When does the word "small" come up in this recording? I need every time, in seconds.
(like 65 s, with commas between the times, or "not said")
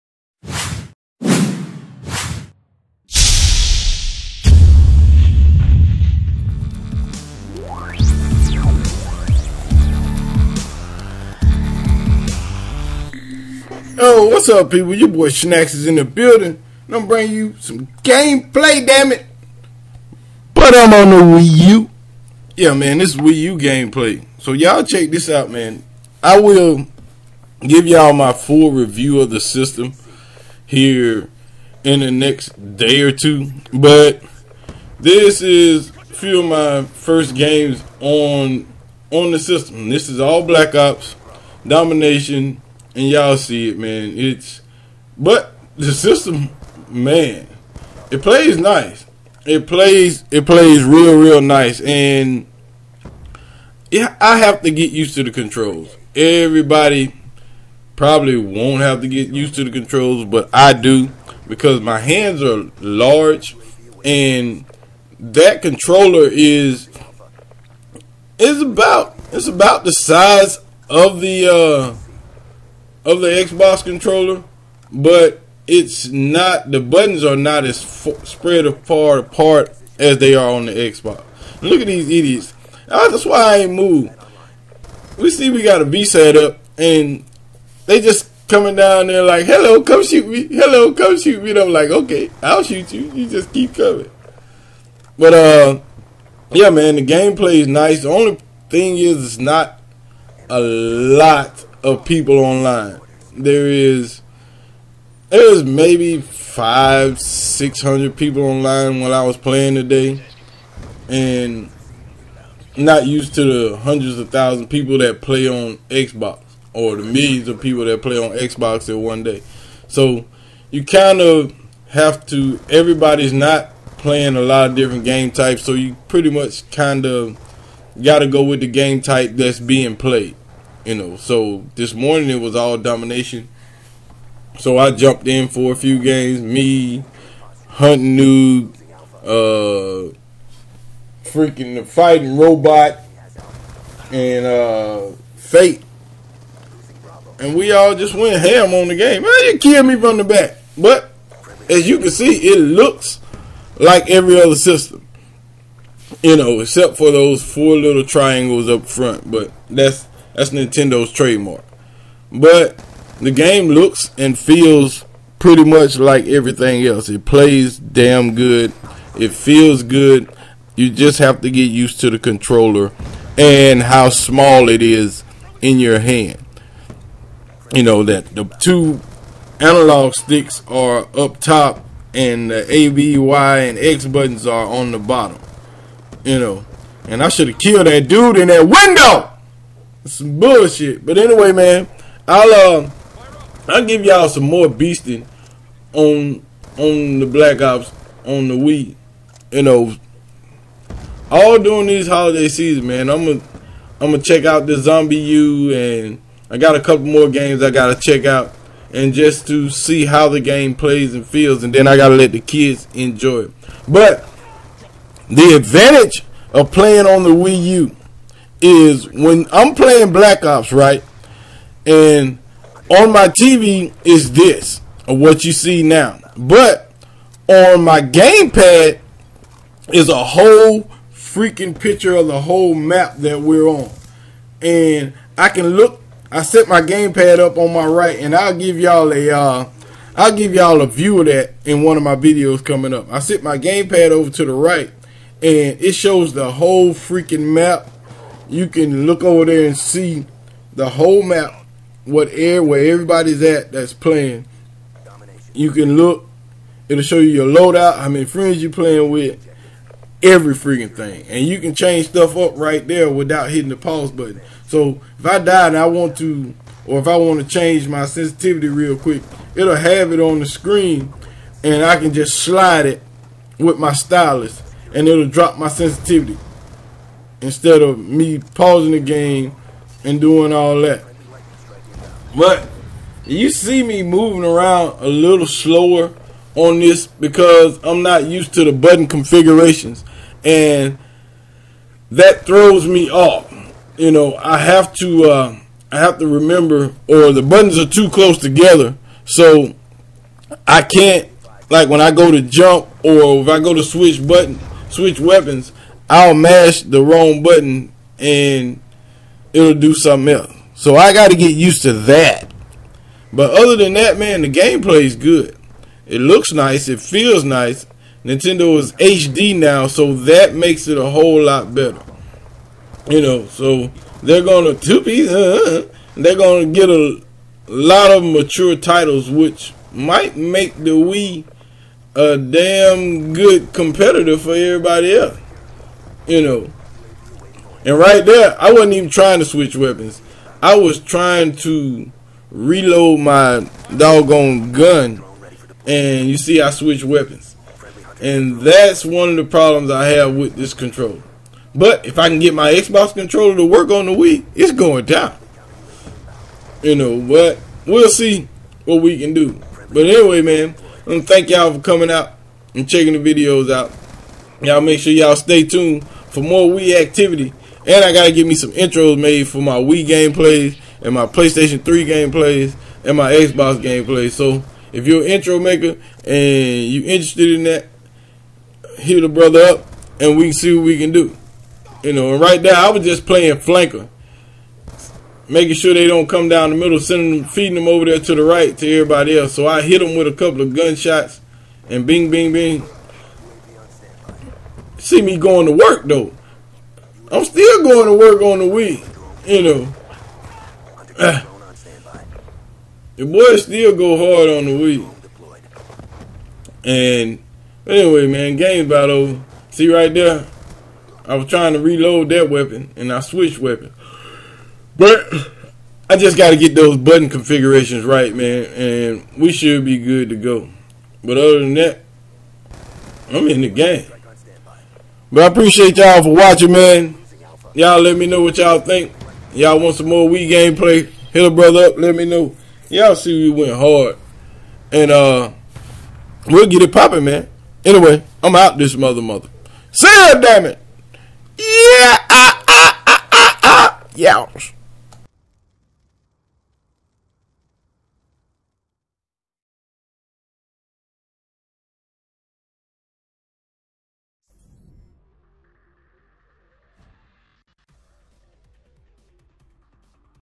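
174 s.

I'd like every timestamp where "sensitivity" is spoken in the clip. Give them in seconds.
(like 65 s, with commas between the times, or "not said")
268 s, 275 s.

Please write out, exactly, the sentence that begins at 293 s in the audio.
You know, I have to uh, I have to remember or the buttons are too close together.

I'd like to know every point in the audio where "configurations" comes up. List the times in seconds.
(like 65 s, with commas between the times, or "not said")
289 s, 417 s.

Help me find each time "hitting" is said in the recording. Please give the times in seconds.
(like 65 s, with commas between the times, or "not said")
263 s.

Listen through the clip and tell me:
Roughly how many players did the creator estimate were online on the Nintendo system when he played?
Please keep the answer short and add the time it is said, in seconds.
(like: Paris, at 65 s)
500-600, at 106 s.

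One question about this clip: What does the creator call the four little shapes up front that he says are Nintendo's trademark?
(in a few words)
triangles.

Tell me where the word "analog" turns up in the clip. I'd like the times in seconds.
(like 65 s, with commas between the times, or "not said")
179 s.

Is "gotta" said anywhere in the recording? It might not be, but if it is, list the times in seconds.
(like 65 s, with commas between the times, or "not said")
207 s, 211 s, 368 s.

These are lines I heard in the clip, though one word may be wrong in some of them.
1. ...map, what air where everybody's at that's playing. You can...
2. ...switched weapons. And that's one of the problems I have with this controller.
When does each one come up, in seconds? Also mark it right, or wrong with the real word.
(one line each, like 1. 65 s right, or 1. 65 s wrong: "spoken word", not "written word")
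1. 251 s right
2. 346 s right.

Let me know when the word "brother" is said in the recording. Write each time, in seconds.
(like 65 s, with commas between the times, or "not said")
379 s, 431 s.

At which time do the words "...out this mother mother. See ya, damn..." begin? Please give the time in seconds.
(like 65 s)
438 s.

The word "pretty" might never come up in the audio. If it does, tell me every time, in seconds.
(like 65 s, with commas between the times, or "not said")
126 s, 165 s.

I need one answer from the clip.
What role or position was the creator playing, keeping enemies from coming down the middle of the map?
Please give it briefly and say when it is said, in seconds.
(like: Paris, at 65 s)
flanker, at 383 s.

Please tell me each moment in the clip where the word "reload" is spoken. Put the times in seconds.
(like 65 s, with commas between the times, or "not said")
342 s, 411 s.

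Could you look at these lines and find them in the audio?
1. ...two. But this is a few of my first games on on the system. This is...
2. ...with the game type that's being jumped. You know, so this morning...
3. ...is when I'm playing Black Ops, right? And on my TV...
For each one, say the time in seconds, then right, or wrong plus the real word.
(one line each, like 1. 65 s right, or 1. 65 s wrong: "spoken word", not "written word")
1. 33 s right
2. 128 s wrong: "played", not "jumped"
3. 218 s right.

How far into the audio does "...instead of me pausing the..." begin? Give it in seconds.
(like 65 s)
277 s.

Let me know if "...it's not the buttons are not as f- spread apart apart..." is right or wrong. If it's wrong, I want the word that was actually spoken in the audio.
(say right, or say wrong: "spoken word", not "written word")
right.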